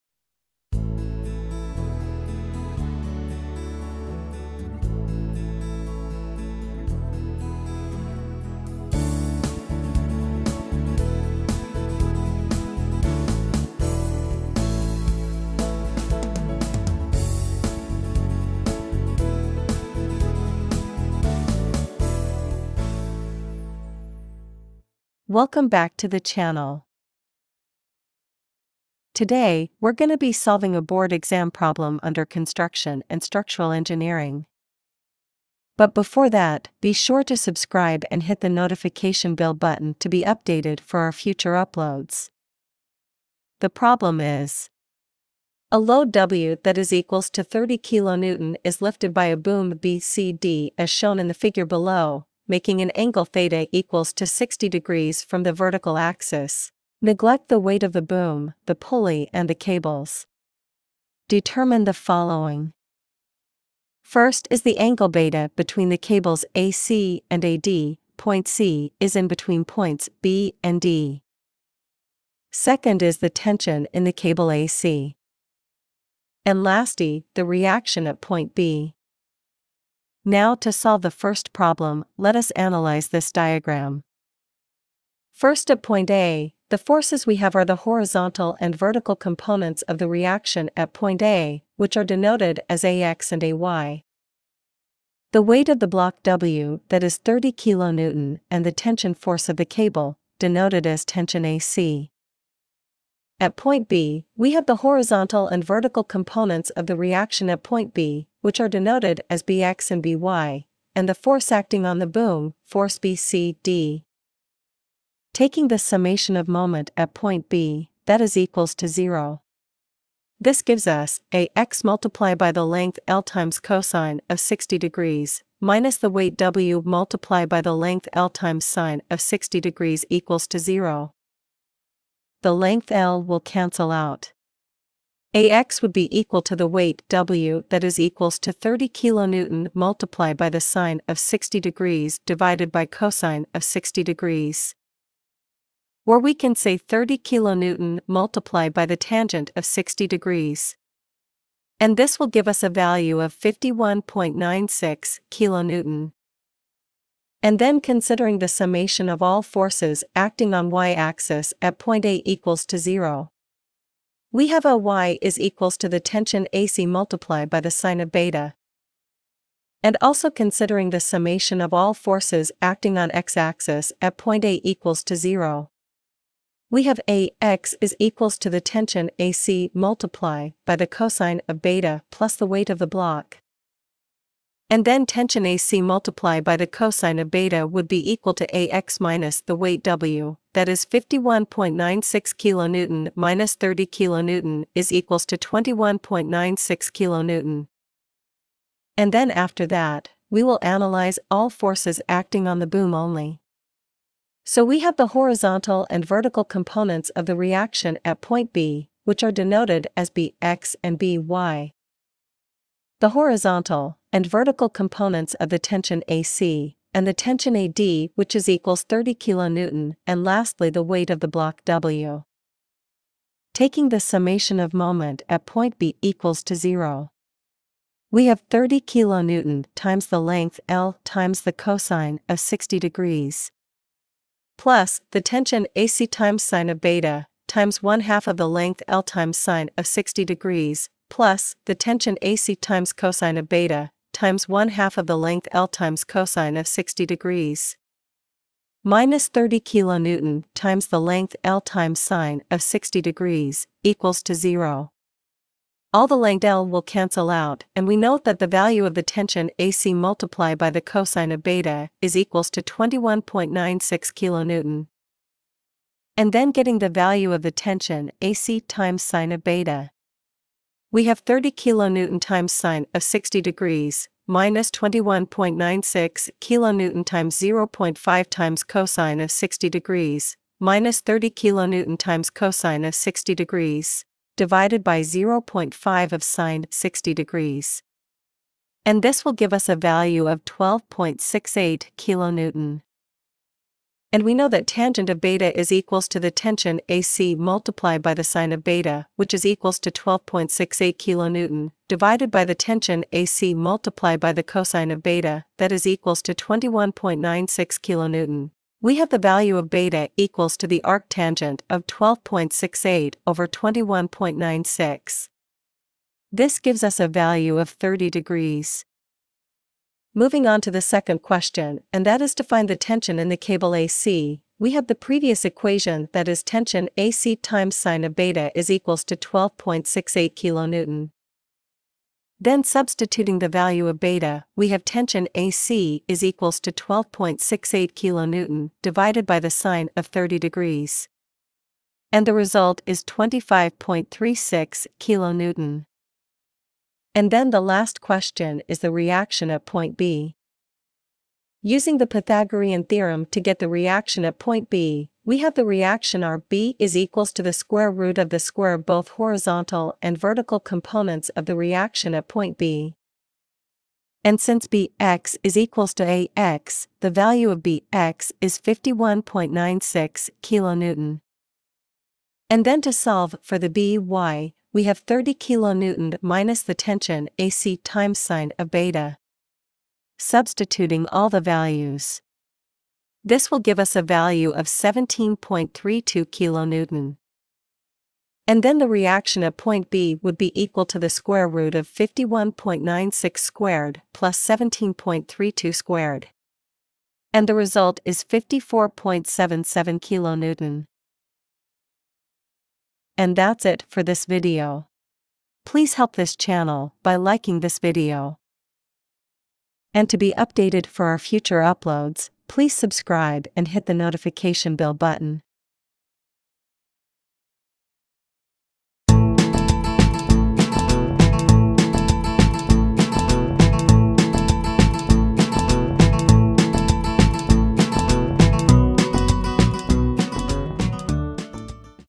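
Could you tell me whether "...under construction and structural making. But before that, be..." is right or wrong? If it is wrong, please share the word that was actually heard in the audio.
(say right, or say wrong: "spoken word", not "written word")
wrong: "engineering", not "making".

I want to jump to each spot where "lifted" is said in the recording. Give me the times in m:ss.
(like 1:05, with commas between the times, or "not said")
0:48.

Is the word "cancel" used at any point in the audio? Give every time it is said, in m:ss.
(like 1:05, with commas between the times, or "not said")
2:13, 4:16.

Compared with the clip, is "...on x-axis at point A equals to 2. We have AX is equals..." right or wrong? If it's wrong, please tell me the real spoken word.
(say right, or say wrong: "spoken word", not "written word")
wrong: "0", not "2".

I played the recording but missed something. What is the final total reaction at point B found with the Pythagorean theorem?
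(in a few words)
54.77 kN.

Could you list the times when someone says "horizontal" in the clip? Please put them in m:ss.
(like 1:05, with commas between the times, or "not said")
1:27, 1:44, 3:25, 3:33, 5:59.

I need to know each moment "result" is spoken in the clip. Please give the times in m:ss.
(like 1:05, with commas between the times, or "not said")
5:42, 6:37.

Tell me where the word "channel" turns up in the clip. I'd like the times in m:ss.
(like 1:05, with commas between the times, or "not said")
0:26, 6:46.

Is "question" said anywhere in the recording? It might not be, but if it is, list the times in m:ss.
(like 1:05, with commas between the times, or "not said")
5:21, 5:48.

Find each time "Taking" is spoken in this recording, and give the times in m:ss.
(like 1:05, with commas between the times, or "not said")
1:55, 3:43.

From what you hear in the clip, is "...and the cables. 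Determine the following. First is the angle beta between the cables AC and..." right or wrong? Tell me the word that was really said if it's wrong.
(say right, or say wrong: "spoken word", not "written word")
right.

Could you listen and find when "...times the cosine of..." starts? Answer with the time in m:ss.
3:51.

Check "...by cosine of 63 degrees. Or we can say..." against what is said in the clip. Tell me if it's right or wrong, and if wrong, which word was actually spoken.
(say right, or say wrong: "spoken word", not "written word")
wrong: "60", not "63".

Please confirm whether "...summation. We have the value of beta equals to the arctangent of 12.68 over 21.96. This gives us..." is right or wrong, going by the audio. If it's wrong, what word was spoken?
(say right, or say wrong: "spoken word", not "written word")
wrong: "kilonewton", not "summation".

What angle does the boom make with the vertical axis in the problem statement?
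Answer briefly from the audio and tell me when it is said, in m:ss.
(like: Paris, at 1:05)
60 degrees, at 0:53.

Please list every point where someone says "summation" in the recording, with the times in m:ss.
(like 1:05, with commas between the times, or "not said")
1:55, 2:38, 2:51, 3:43.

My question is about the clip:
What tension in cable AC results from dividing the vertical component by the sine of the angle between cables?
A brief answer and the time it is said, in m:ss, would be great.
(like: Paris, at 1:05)
25.36 kN, at 5:43.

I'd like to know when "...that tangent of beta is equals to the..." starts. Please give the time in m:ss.
4:54.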